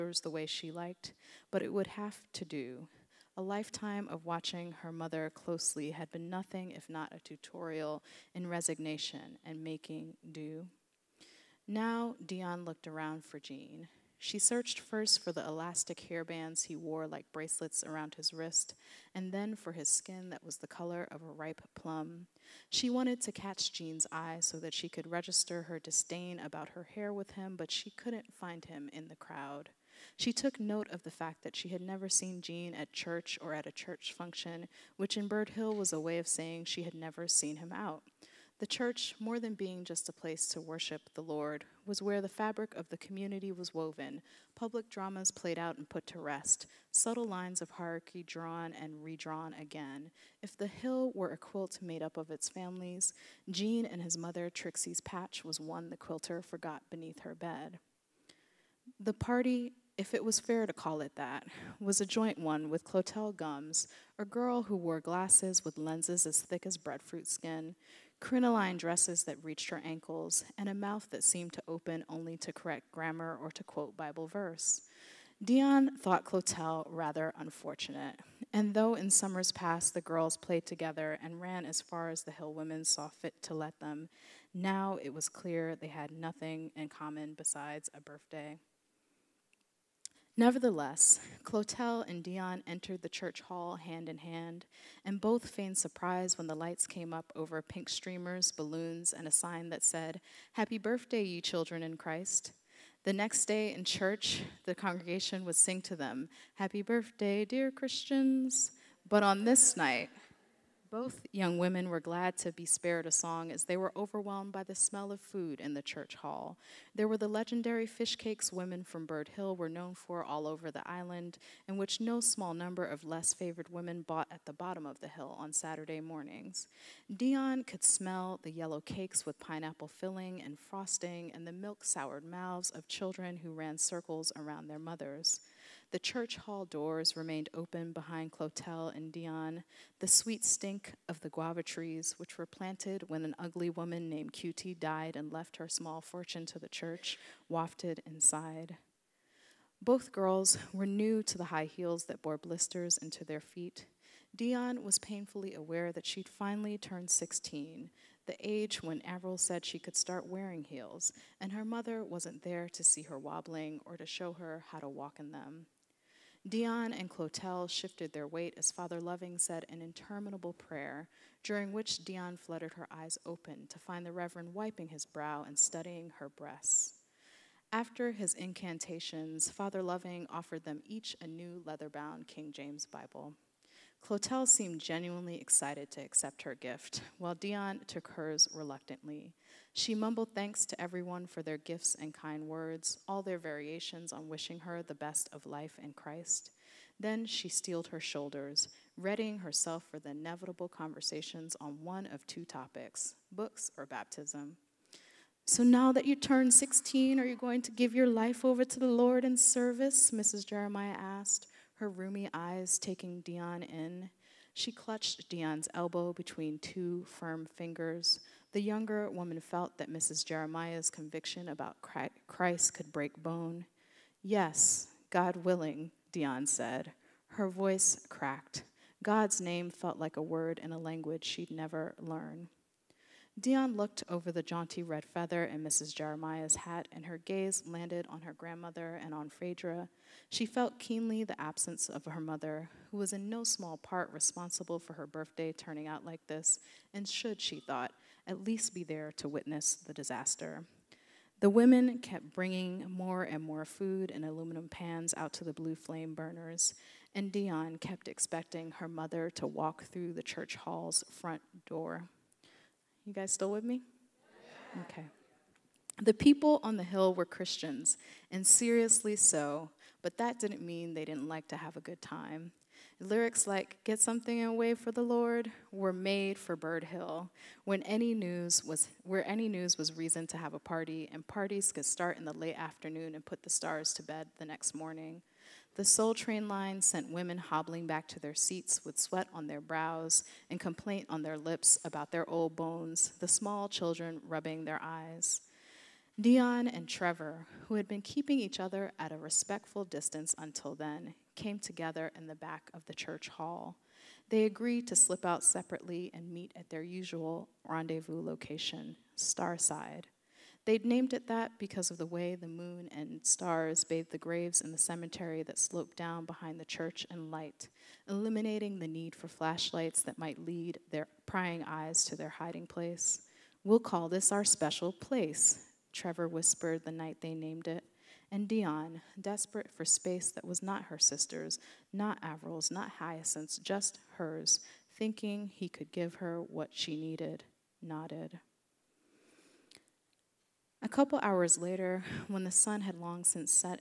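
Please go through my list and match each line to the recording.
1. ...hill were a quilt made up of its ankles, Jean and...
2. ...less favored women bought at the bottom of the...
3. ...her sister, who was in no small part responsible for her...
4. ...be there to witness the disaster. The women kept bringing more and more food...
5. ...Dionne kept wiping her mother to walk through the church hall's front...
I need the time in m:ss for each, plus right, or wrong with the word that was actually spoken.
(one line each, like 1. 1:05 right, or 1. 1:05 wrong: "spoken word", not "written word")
1. 0:50 wrong: "families", not "ankles"
2. 2:03 right
3. 4:02 wrong: "mother", not "sister"
4. 4:08 right
5. 4:17 wrong: "expecting", not "wiping".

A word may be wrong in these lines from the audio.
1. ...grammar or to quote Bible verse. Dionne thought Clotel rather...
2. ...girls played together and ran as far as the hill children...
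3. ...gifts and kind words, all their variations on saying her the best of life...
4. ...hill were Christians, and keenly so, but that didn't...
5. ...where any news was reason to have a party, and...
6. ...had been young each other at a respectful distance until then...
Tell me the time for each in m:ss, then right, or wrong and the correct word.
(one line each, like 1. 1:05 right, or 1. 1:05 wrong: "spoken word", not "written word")
1. 1:12 right
2. 1:20 wrong: "women", not "children"
3. 3:11 wrong: "wishing", not "saying"
4. 4:26 wrong: "seriously", not "keenly"
5. 4:39 right
6. 4:57 wrong: "keeping", not "young".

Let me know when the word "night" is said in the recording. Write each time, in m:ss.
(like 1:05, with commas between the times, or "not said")
1:49, 5:26.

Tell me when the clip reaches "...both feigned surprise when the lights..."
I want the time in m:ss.
1:35.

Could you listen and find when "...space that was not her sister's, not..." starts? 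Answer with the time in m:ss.
5:29.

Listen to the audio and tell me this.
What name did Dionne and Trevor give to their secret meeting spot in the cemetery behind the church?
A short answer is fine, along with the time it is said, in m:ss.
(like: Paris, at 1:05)
Starside, at 5:09.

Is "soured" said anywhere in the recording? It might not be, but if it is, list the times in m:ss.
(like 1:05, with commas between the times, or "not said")
2:11.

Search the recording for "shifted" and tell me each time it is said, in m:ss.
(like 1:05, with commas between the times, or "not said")
2:47.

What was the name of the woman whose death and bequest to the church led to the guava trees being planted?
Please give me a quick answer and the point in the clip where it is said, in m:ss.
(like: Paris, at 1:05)
QT, at 2:24.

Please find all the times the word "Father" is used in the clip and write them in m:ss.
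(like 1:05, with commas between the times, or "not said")
2:48, 2:59.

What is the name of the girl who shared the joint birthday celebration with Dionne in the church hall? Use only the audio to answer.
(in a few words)
Clotel Gums.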